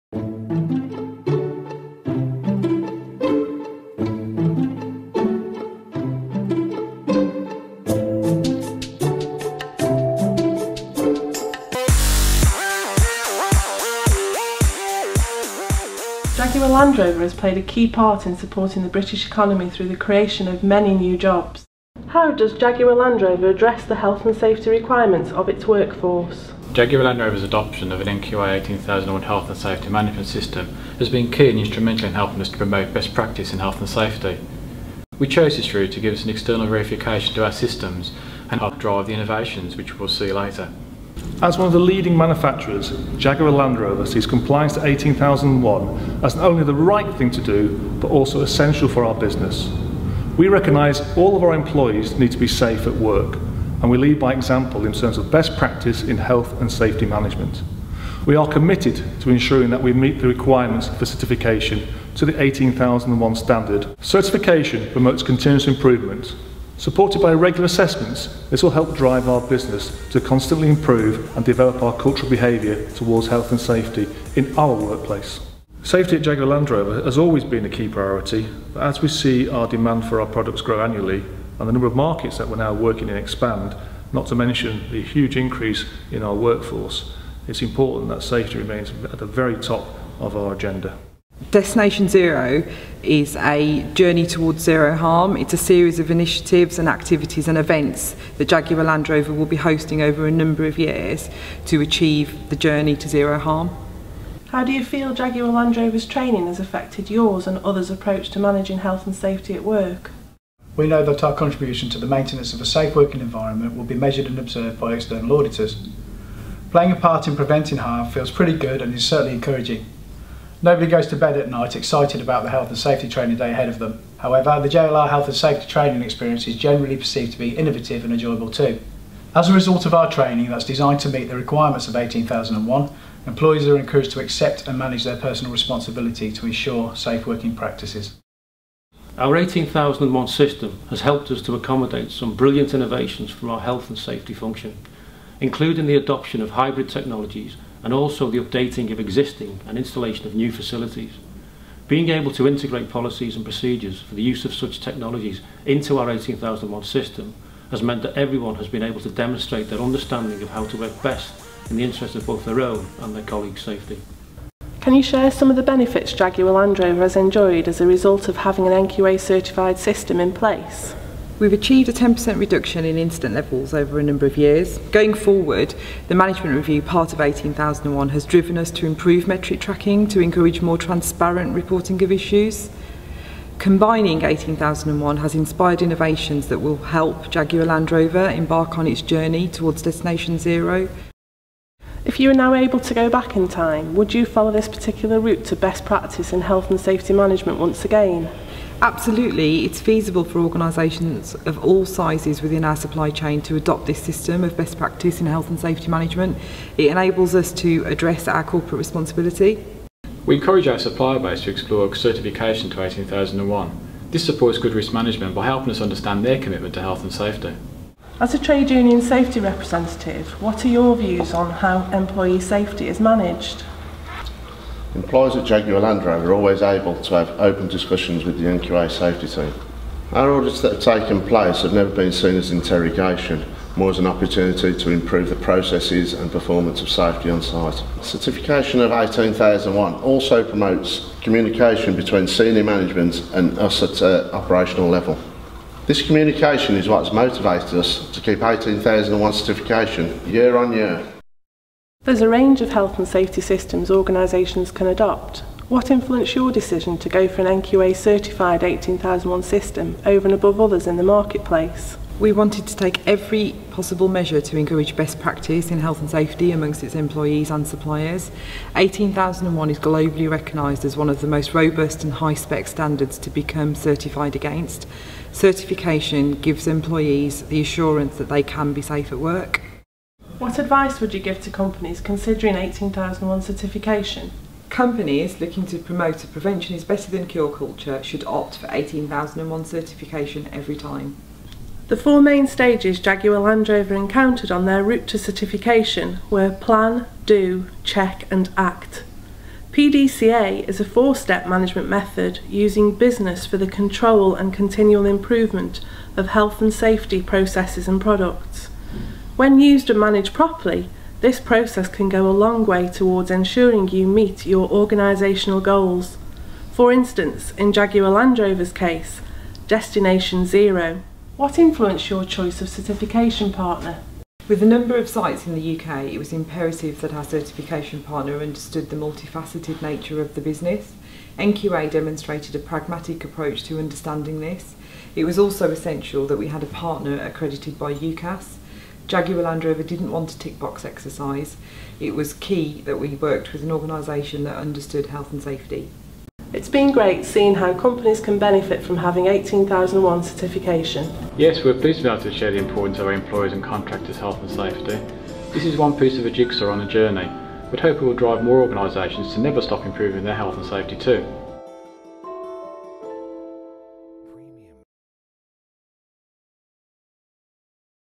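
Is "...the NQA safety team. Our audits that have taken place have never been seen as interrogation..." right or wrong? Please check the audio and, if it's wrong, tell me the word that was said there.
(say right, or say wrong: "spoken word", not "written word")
right.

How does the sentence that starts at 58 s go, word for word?
We are committed to ensuring that we meet the requirements for certification to the 18001 standard.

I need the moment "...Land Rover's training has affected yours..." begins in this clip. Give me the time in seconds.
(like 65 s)
105 s.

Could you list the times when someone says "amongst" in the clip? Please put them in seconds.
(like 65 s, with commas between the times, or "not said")
266 s.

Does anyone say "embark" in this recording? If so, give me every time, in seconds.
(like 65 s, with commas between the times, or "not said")
188 s.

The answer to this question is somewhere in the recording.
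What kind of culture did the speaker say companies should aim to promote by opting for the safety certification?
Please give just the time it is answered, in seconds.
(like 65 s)
286 s.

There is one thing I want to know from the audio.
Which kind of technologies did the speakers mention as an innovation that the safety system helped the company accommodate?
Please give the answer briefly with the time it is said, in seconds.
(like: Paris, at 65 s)
Hybrid technologies, at 146 s.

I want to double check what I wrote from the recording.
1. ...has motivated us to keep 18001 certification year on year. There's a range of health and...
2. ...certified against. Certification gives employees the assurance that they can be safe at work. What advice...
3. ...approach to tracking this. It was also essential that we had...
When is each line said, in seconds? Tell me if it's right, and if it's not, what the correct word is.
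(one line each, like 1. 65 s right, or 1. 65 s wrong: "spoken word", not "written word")
1. 247 s right
2. 273 s right
3. 333 s wrong: "understanding", not "tracking".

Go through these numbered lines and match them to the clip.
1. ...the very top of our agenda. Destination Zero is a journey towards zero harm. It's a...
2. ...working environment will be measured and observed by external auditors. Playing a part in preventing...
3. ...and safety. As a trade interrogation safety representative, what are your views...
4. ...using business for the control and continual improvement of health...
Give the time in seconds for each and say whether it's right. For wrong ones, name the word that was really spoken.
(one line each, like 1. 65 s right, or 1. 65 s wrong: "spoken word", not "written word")
1. 89 s right
2. 112 s right
3. 217 s wrong: "union", not "interrogation"
4. 302 s right.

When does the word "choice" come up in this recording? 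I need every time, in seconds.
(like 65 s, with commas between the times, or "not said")
322 s.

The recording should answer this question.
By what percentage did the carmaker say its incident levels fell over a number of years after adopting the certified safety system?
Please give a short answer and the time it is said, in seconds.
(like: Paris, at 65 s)
10%, at 171 s.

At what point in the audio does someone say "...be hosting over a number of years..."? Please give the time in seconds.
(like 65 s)
99 s.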